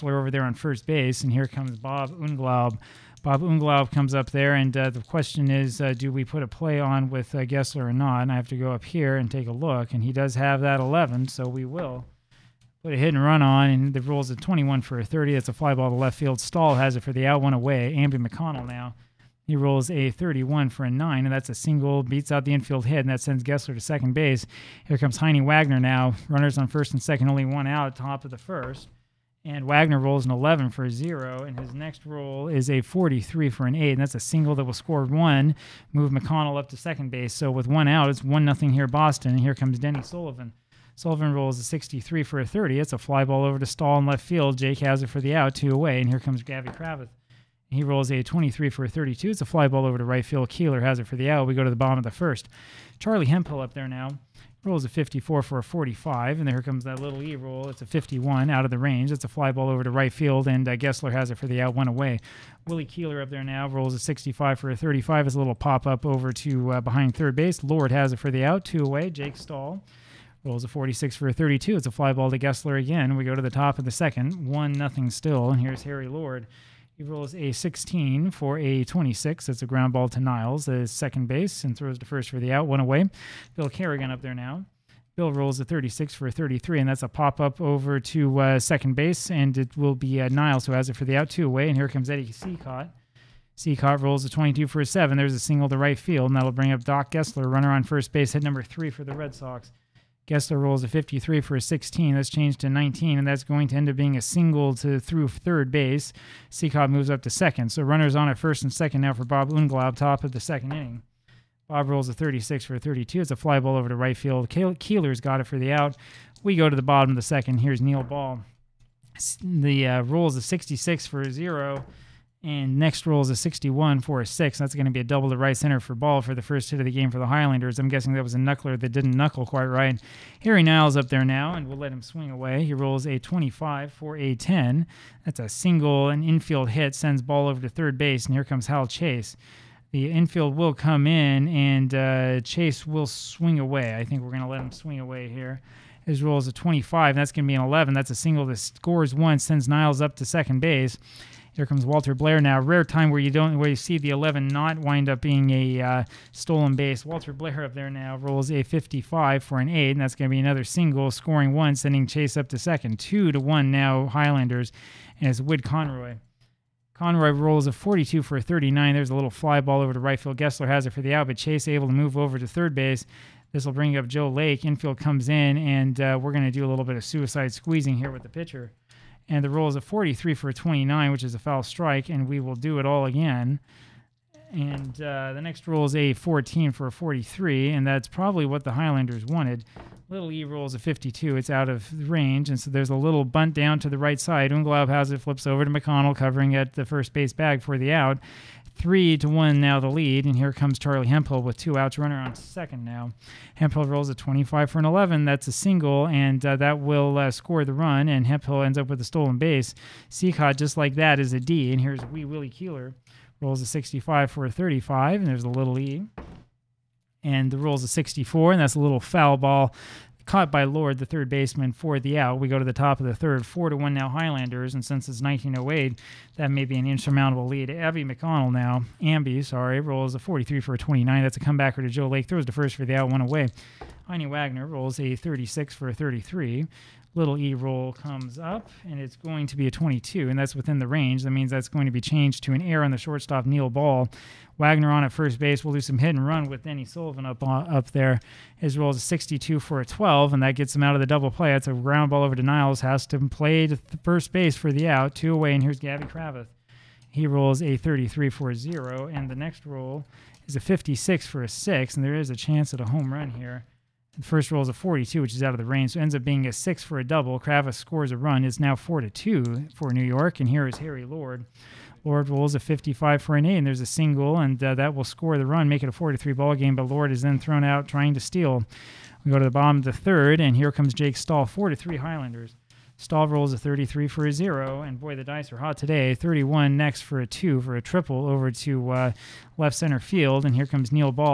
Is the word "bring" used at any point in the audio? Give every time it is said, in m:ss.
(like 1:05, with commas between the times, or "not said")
1:36, 2:53.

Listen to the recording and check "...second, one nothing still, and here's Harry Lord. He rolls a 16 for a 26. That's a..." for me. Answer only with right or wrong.
right.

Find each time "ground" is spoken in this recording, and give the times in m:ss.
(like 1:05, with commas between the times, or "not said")
1:19, 4:11.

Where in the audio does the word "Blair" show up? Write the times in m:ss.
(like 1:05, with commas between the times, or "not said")
2:32, 2:37.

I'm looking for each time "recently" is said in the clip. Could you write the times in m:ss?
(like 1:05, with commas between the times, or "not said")
not said.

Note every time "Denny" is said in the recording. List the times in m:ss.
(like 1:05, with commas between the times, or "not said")
0:39, 4:06.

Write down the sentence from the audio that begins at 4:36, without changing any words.
But Lord is then thrown out trying to steal.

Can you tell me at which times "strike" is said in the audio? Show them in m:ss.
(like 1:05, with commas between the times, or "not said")
3:01.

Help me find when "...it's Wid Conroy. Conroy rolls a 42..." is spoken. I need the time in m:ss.
2:45.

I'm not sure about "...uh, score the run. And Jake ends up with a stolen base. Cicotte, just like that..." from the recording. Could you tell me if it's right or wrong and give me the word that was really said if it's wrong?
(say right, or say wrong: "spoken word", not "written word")
wrong: "Hemphill", not "Jake".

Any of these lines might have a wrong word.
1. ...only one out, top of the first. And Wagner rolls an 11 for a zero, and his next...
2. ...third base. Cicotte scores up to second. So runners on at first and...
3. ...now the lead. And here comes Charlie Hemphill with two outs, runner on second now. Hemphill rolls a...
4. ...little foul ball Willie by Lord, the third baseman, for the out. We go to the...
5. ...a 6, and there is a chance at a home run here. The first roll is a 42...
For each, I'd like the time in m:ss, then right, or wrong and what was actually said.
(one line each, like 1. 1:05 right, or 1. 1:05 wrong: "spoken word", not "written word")
1. 0:27 right
2. 1:45 wrong: "moves", not "scores"
3. 3:19 right
4. 3:38 wrong: "Caught", not "Willie"
5. 4:21 right.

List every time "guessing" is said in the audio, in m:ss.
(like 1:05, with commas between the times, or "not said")
2:07.